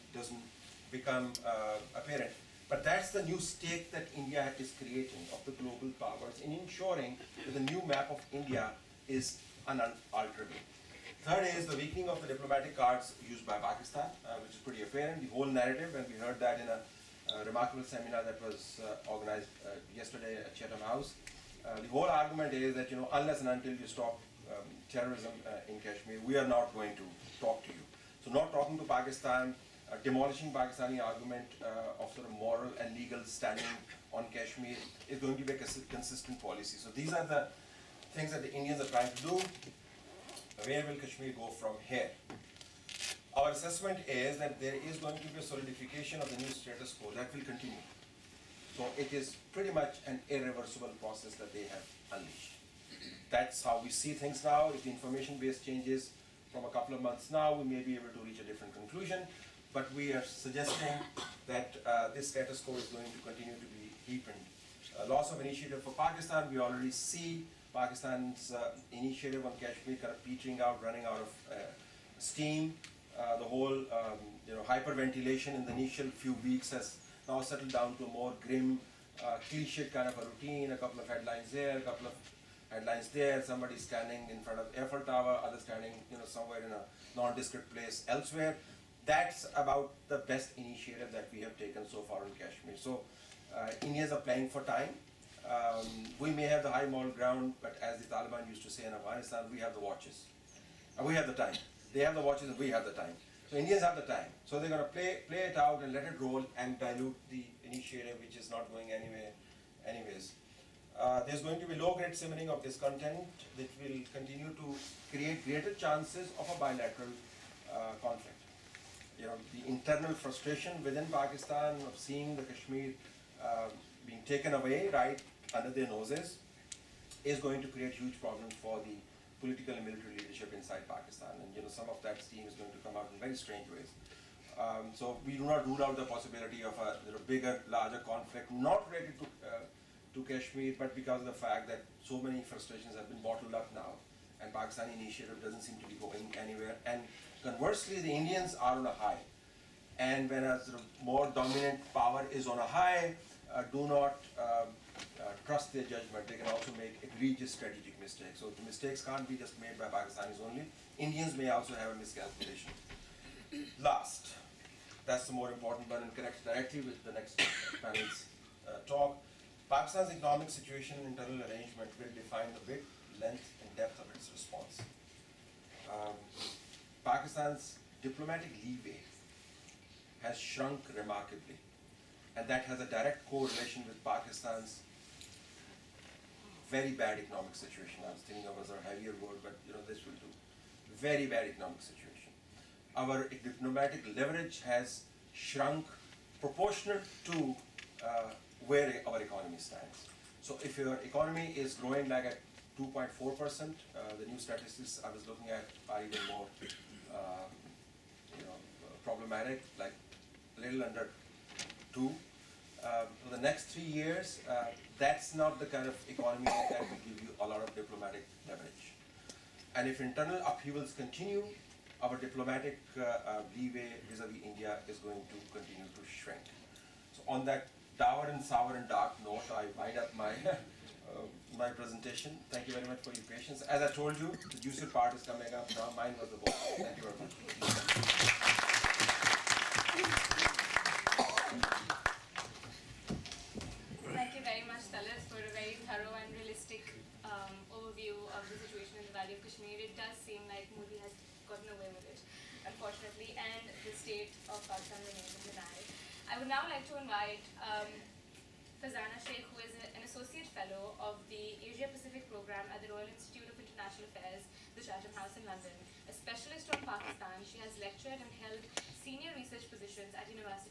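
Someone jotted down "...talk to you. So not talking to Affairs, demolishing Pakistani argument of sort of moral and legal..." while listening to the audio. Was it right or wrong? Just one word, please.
wrong.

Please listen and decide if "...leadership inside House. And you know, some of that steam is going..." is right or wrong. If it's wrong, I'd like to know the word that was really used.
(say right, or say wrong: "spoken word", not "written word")
wrong: "Pakistan", not "House".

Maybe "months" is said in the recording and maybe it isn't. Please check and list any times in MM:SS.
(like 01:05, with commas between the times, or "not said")
00:57.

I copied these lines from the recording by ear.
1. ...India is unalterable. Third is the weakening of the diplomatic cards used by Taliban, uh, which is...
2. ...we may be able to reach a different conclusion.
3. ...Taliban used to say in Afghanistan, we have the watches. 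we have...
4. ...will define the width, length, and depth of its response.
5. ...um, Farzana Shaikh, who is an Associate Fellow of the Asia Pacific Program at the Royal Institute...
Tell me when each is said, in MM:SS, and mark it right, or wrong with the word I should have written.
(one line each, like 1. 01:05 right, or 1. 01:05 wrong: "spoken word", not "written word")
1. 00:08 wrong: "Pakistan", not "Taliban"
2. 00:57 right
3. 01:38 right
4. 02:51 right
5. 04:17 right.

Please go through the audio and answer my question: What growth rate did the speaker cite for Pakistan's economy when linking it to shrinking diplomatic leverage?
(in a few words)
2.4 percent.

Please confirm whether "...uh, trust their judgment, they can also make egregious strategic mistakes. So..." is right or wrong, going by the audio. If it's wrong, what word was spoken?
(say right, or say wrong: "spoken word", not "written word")
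right.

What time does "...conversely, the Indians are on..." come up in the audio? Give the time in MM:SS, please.
02:27.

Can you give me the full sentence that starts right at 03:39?
And if internal upheavals continue, our diplomatic uh, uh, leeway vis-a-vis India is going to continue to shrink.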